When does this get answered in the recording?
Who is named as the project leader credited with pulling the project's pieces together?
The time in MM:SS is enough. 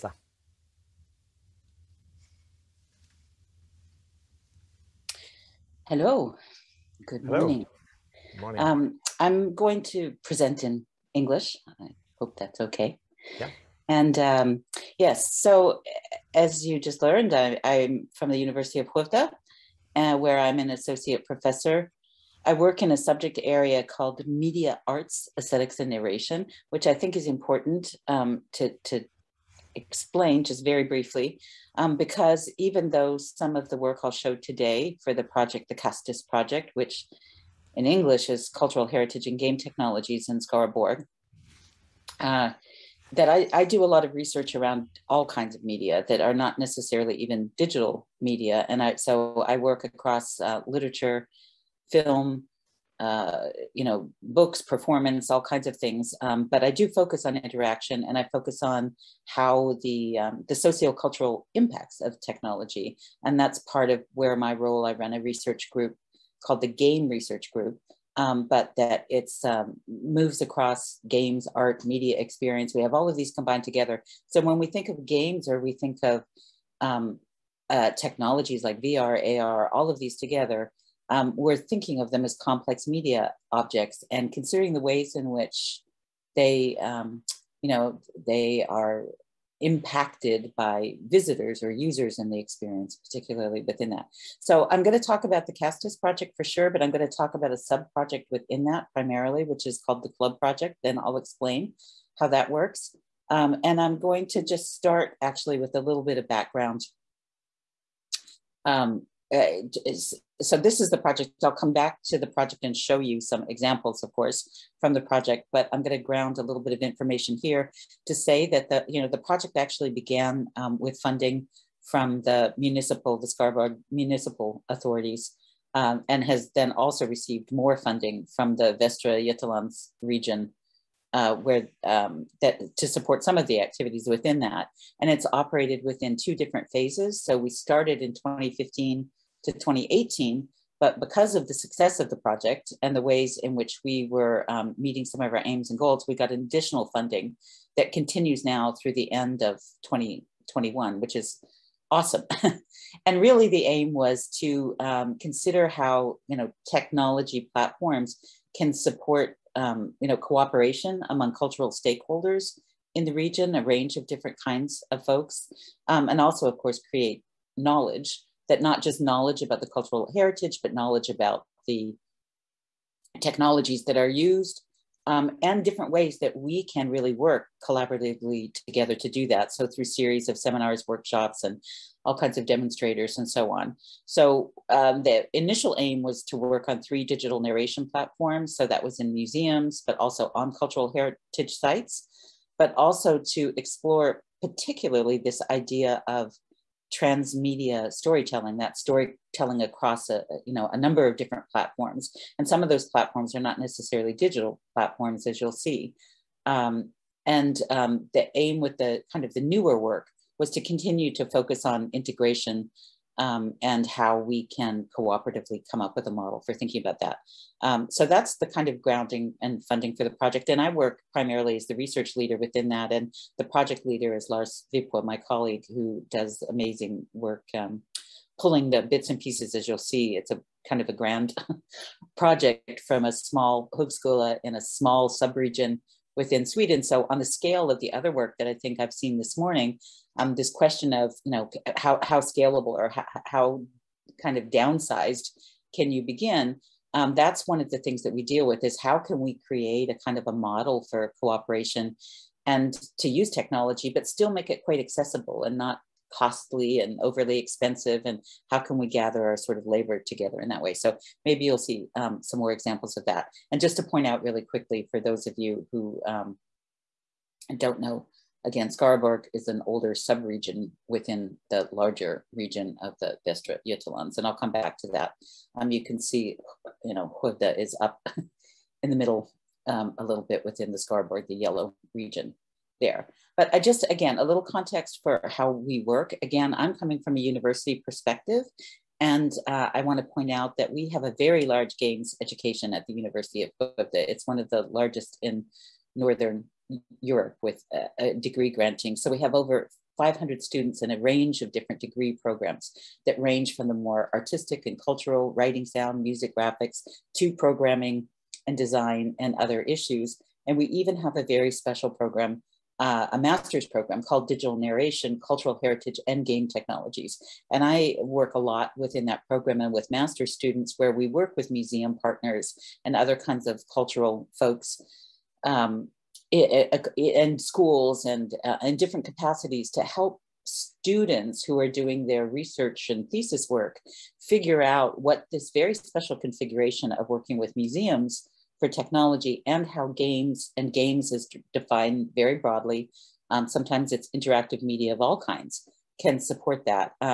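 03:44.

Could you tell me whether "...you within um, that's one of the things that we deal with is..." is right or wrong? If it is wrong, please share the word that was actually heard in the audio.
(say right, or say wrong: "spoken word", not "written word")
wrong: "begin", not "within".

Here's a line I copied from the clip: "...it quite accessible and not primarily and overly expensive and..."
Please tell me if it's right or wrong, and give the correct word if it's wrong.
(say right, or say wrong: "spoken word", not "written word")
wrong: "costly", not "primarily".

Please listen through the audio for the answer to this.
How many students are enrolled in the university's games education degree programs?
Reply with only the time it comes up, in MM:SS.
04:59.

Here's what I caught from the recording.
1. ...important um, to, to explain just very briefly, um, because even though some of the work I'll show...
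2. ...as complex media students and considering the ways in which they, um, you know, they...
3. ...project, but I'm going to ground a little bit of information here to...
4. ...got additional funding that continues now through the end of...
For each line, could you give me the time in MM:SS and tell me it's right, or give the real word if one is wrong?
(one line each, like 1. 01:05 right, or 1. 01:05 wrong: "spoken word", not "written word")
1. 00:27 right
2. 01:22 wrong: "objects", not "students"
3. 01:54 right
4. 02:26 right.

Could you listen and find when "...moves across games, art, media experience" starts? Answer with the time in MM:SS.
01:09.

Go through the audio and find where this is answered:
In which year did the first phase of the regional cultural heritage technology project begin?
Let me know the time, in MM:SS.
02:18.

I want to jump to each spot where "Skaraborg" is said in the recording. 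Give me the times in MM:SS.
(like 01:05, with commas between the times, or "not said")
00:40, 02:03, 04:28, 04:40.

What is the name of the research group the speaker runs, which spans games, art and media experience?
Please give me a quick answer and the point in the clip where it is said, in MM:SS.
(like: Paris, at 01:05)
Game Research Group, at 01:06.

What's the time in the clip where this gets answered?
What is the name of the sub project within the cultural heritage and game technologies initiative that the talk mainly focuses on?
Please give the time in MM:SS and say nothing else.
01:40.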